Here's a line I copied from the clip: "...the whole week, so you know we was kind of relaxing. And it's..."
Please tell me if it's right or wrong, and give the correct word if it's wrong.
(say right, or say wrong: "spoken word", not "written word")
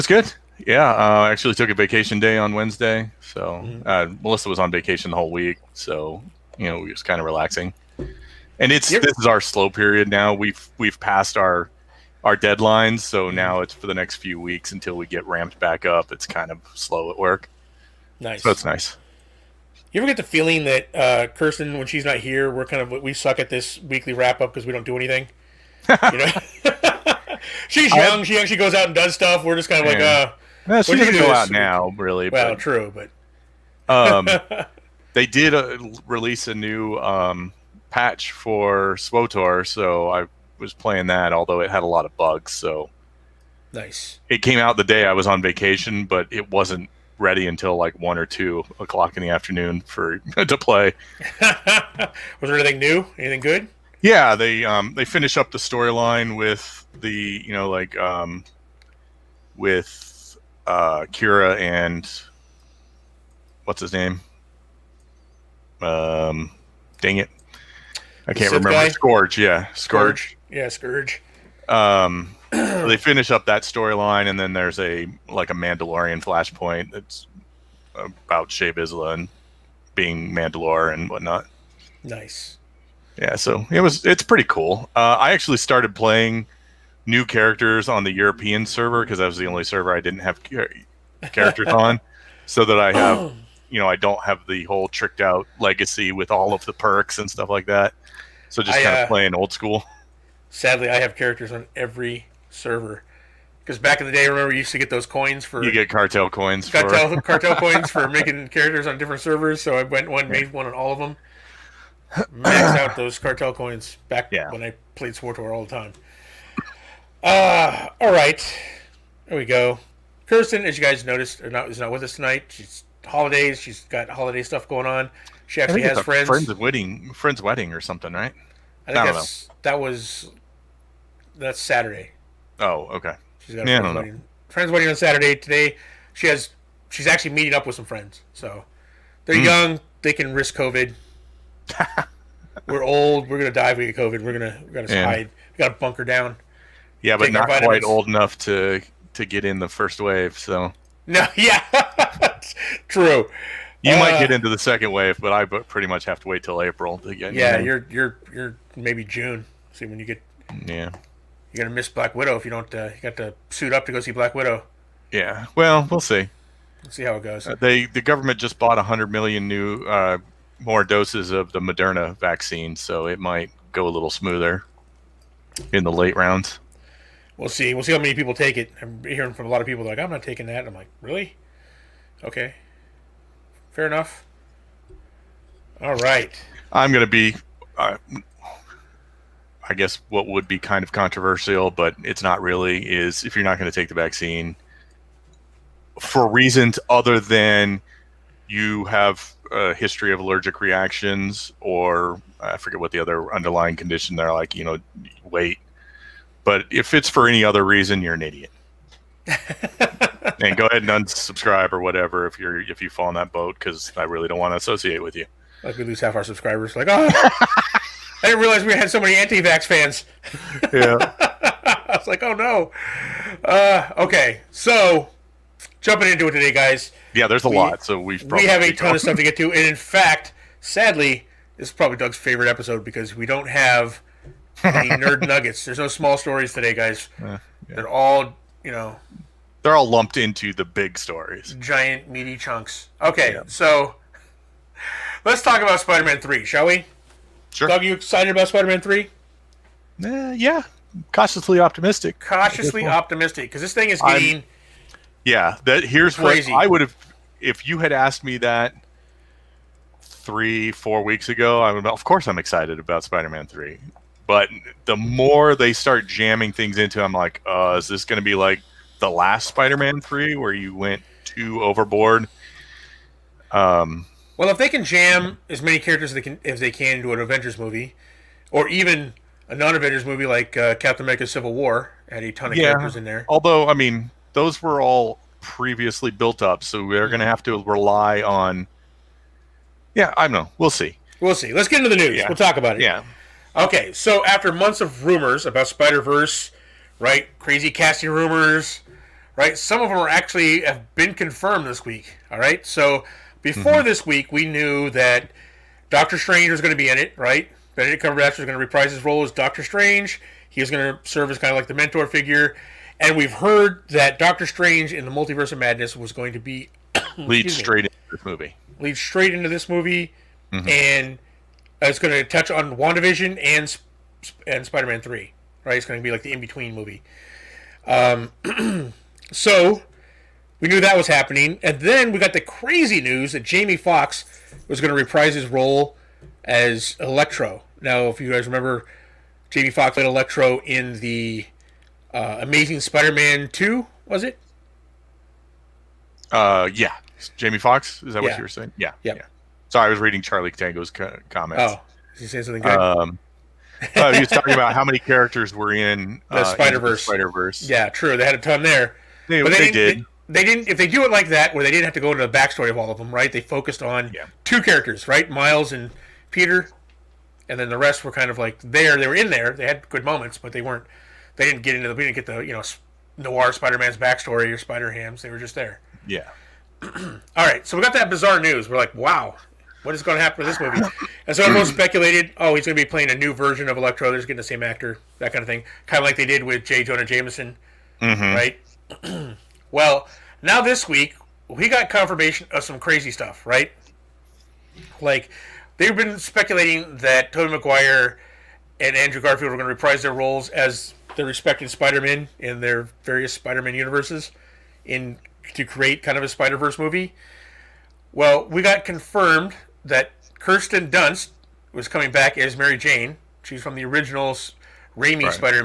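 right.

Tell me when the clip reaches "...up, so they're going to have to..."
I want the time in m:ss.
4:46.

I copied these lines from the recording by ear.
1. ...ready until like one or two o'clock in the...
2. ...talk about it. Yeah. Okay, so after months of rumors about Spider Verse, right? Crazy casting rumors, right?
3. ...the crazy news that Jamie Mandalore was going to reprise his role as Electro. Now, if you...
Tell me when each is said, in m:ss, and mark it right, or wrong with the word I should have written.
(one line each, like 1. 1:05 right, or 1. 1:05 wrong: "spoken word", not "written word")
1. 0:47 right
2. 4:52 right
3. 5:32 wrong: "Foxx", not "Mandalore".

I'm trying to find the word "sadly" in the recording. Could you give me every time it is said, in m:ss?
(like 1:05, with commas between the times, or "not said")
1:40, 3:50.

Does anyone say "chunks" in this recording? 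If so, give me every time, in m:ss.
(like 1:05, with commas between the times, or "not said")
4:02.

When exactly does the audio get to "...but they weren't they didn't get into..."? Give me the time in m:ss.
6:10.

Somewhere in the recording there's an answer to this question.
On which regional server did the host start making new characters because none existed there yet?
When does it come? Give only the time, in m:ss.
1:28.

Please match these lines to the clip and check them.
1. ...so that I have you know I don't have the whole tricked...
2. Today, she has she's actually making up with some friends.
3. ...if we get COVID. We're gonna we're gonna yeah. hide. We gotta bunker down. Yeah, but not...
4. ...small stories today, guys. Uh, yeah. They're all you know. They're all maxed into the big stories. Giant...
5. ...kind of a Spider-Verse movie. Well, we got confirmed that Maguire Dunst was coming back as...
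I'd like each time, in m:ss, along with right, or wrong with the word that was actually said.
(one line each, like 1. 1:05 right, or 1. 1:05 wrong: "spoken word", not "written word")
1. 1:32 right
2. 2:15 wrong: "meeting", not "making"
3. 2:23 right
4. 3:55 wrong: "lumped", not "maxed"
5. 6:46 wrong: "Kirsten", not "Maguire".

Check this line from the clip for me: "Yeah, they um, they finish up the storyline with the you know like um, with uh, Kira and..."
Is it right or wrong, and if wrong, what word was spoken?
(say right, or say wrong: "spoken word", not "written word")
right.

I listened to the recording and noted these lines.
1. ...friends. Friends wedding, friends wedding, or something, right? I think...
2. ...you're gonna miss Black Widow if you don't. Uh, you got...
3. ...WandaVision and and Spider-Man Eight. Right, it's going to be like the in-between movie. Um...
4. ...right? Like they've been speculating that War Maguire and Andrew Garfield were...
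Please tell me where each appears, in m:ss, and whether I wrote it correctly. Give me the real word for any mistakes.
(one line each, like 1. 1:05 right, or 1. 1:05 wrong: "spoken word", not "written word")
1. 2:05 right
2. 2:41 right
3. 5:22 wrong: "Three", not "Eight"
4. 6:33 wrong: "Tobey", not "War".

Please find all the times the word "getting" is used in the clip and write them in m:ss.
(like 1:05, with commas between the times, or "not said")
4:14, 6:24.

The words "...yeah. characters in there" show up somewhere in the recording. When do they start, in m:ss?
4:42.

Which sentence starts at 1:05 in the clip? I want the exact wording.
Um, dang it, I can't remember.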